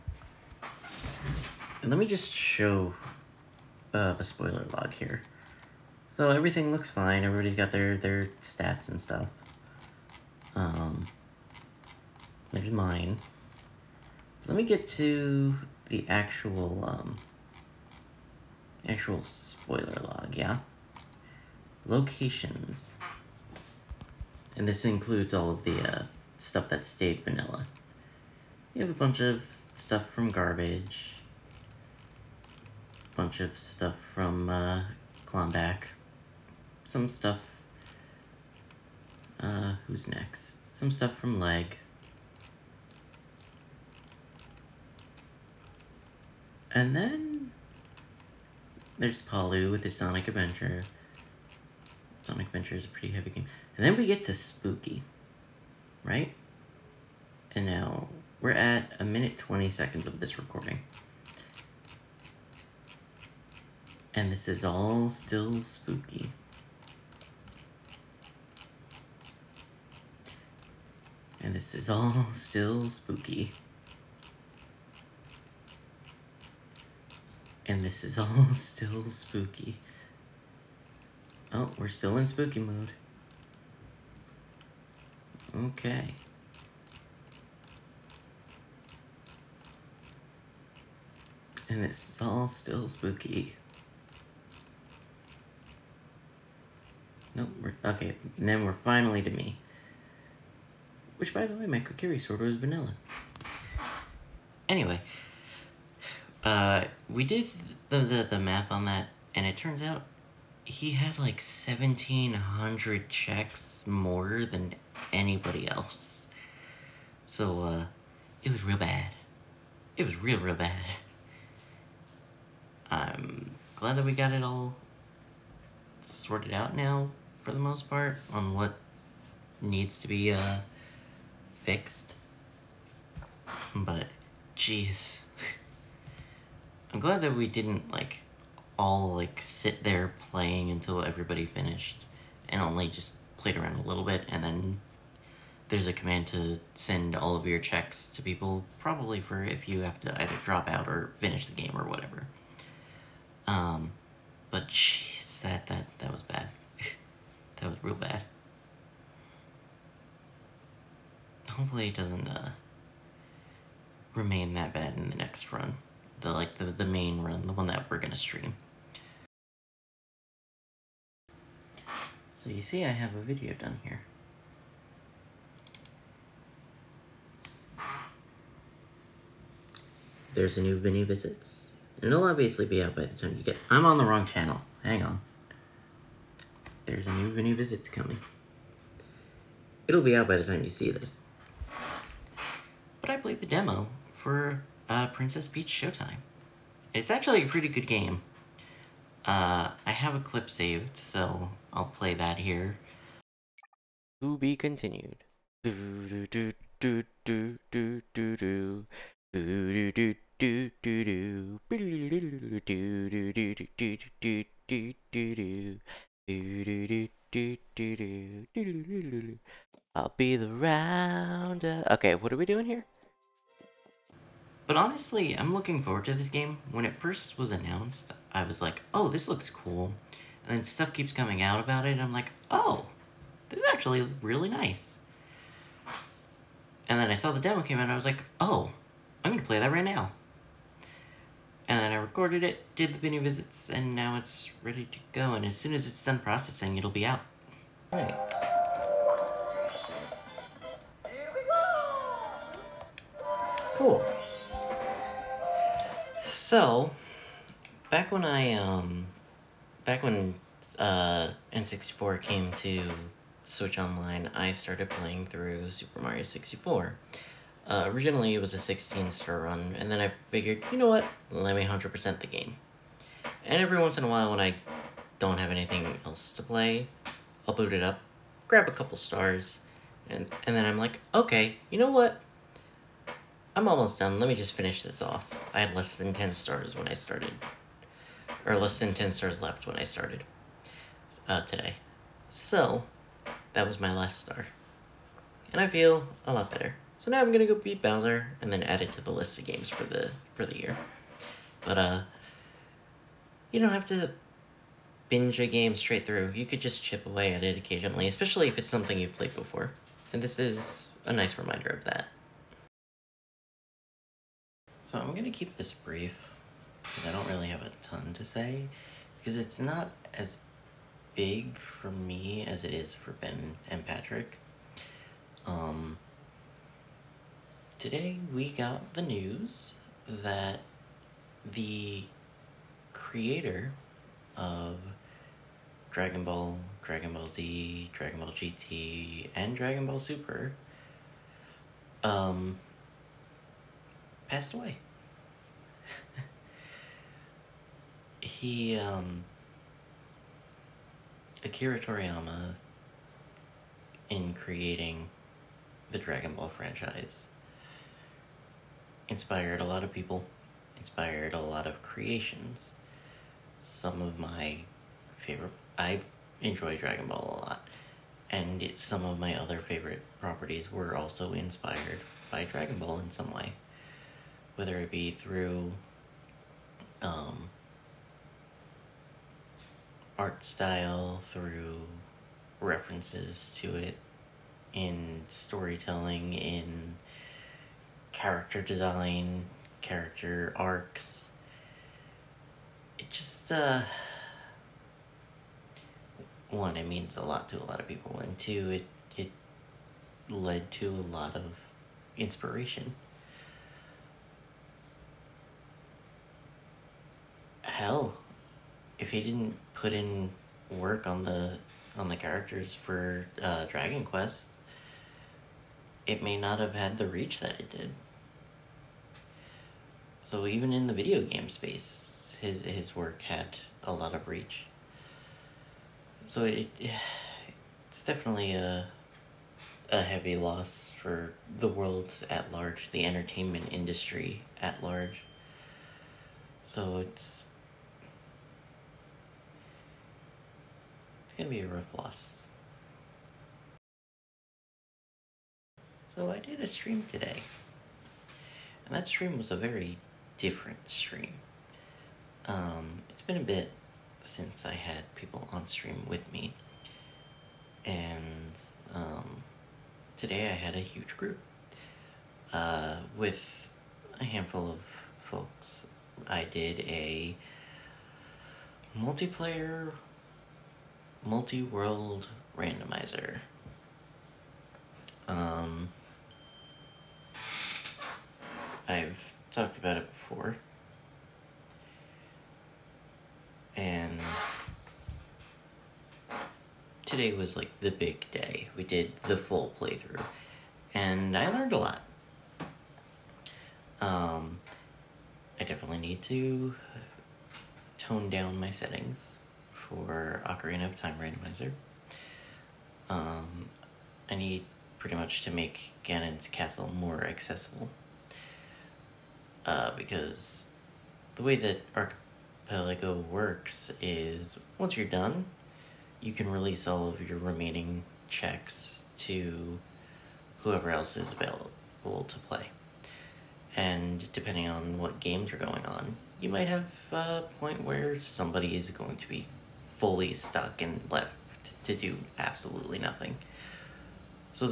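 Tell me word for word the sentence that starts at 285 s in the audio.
I had less than 10 stars when I started, or less than 10 stars left when I started uh, today.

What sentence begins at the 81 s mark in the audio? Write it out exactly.
Oh, we're still in spooky mode.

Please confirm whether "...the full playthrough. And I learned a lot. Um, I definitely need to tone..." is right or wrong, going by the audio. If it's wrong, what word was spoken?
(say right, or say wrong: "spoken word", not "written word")
right.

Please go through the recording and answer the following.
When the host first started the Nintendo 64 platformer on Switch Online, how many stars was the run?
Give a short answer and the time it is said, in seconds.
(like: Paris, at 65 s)
16 star, at 268 s.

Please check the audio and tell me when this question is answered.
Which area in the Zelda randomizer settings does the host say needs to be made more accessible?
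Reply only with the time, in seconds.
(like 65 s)
506 s.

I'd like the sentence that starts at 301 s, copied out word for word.
But uh you don't have to binge a game straight through.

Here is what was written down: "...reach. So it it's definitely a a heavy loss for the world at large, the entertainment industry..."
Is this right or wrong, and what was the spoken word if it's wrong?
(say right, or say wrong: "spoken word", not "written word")
right.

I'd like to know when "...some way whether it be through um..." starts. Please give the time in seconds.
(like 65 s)
373 s.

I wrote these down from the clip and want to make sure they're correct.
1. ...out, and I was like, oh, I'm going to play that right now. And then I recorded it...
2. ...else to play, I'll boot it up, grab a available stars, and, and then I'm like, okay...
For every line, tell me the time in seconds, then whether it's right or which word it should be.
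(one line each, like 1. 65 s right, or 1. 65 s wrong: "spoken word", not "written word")
1. 237 s right
2. 276 s wrong: "couple", not "available".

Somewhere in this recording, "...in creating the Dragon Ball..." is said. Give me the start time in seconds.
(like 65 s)
354 s.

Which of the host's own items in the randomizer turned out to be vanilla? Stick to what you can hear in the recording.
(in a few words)
Kokiri sword.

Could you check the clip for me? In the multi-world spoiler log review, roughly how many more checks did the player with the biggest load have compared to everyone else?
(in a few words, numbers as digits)
1,700.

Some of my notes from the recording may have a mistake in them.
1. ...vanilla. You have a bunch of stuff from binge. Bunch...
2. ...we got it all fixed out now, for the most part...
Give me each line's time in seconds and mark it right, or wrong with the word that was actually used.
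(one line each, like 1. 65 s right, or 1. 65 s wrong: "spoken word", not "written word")
1. 27 s wrong: "garbage", not "binge"
2. 124 s wrong: "sorted", not "fixed".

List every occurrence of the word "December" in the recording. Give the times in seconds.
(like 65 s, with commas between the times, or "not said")
not said.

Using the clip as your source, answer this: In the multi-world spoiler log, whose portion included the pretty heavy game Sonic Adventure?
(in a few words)
Palu.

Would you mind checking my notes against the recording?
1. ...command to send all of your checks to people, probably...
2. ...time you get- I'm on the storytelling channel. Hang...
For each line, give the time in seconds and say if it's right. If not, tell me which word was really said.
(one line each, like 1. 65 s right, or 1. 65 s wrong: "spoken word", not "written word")
1. 145 s right
2. 183 s wrong: "wrong", not "storytelling".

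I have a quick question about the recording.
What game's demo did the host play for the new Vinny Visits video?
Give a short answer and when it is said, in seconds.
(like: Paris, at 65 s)
Princess Peach Showtime, at 195 s.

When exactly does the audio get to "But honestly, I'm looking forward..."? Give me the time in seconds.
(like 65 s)
224 s.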